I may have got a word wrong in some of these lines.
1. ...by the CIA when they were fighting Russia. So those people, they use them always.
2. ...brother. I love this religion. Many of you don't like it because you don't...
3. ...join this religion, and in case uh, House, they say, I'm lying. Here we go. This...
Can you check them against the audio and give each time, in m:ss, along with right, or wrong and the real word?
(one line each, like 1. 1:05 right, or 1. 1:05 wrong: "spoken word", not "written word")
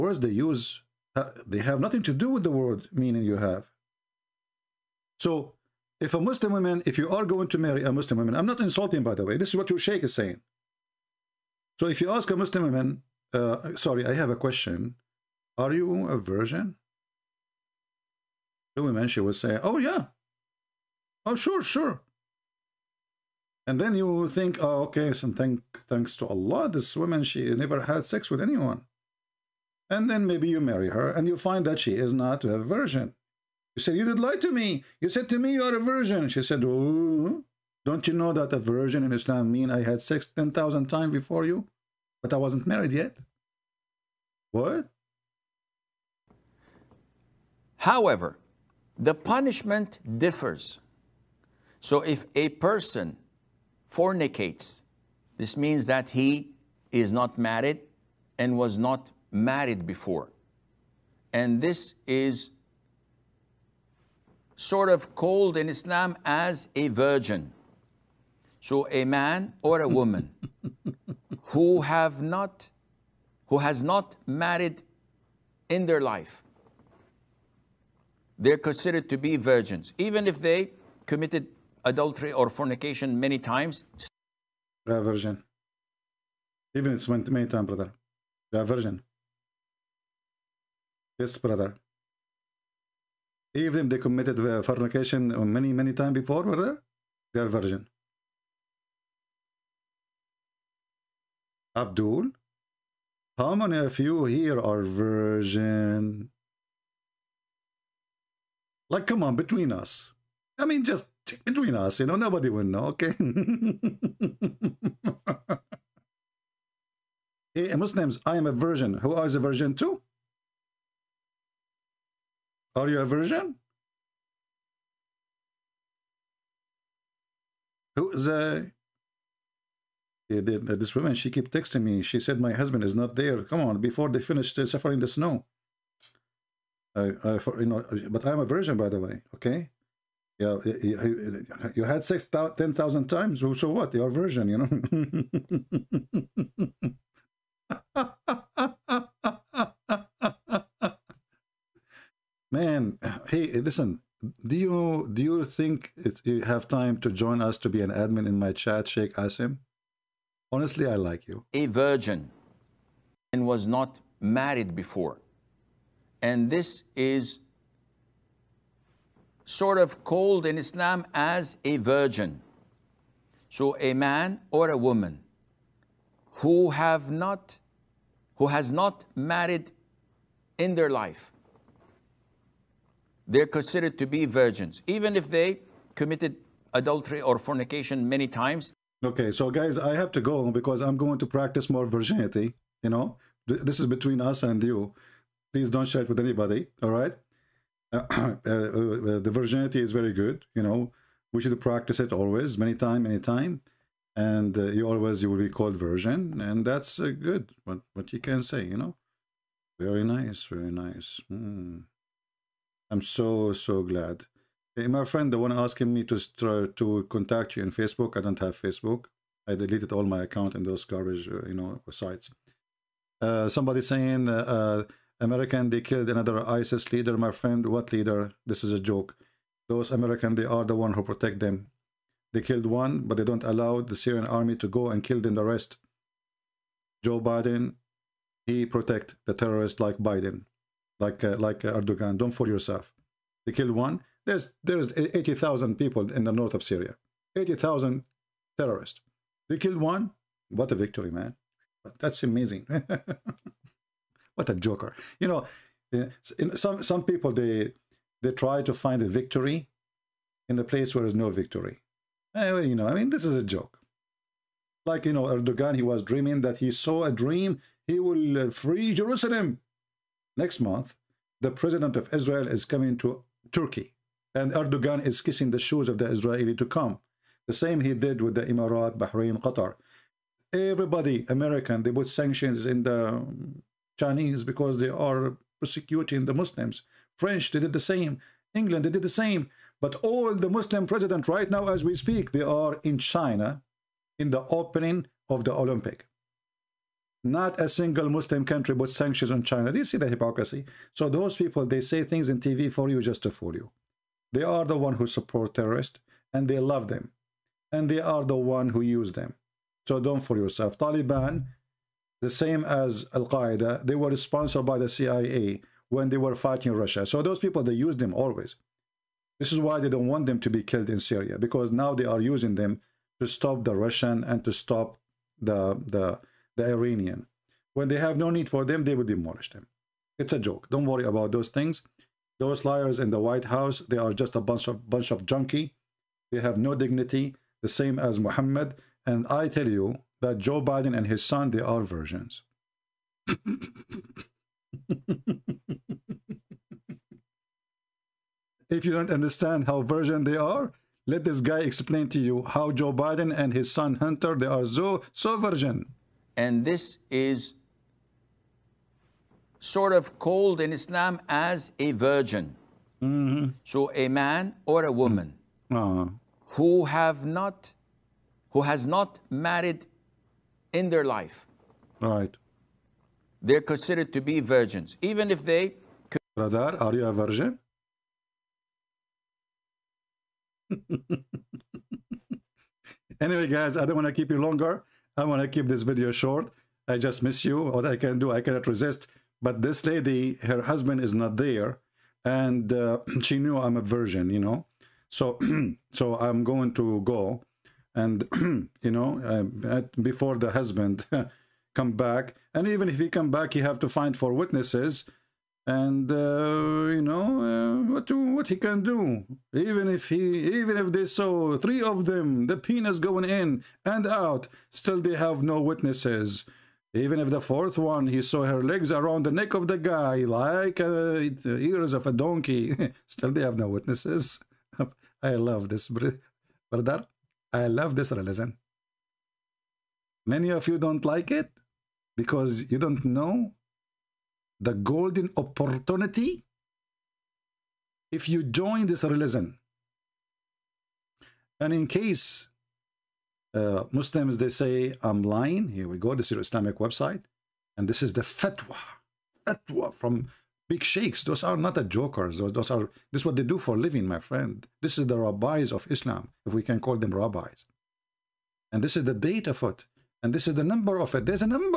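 1. 5:14 right
2. 7:05 right
3. 7:18 wrong: "Muslims", not "House".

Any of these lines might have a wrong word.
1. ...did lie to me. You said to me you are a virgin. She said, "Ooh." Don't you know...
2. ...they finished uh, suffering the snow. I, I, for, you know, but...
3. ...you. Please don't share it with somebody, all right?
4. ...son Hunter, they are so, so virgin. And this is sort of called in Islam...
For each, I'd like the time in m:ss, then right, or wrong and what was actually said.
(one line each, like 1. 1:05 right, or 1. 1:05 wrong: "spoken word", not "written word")
1. 0:34 right
2. 2:14 right
3. 3:14 wrong: "anybody", not "somebody"
4. 5:53 right.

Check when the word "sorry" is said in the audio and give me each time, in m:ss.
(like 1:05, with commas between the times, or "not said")
0:13.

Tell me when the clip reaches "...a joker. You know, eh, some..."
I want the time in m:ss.
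4:14.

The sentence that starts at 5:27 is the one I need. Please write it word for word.
When they have no need for them, they will demolish them.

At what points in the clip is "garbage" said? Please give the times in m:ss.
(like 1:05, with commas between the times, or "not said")
3:40.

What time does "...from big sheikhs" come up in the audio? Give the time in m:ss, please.
7:29.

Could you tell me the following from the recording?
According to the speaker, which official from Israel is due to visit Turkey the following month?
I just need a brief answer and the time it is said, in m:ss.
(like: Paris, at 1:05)
The president of Israel, at 4:31.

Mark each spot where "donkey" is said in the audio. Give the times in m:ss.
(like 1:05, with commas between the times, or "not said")
7:02.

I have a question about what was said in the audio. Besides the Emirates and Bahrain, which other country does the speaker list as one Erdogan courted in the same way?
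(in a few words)
Qatar.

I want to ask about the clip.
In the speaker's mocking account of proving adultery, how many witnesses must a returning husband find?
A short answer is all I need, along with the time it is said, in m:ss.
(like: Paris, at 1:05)
4, at 6:44.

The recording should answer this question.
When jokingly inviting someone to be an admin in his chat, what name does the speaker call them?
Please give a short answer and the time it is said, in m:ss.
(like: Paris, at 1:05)
Sheikh Asim, at 2:38.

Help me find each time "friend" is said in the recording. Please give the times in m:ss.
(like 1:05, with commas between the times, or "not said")
3:35, 3:47, 7:34.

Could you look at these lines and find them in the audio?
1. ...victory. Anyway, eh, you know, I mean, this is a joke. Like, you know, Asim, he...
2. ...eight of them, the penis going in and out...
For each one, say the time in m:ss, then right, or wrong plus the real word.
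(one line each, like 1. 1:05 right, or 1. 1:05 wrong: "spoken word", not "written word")
1. 4:21 wrong: "Erdogan", not "Asim"
2. 6:51 wrong: "three", not "eight".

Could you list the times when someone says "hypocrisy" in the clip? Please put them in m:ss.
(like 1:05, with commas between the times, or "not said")
5:00.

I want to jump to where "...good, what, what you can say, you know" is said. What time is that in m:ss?
3:27.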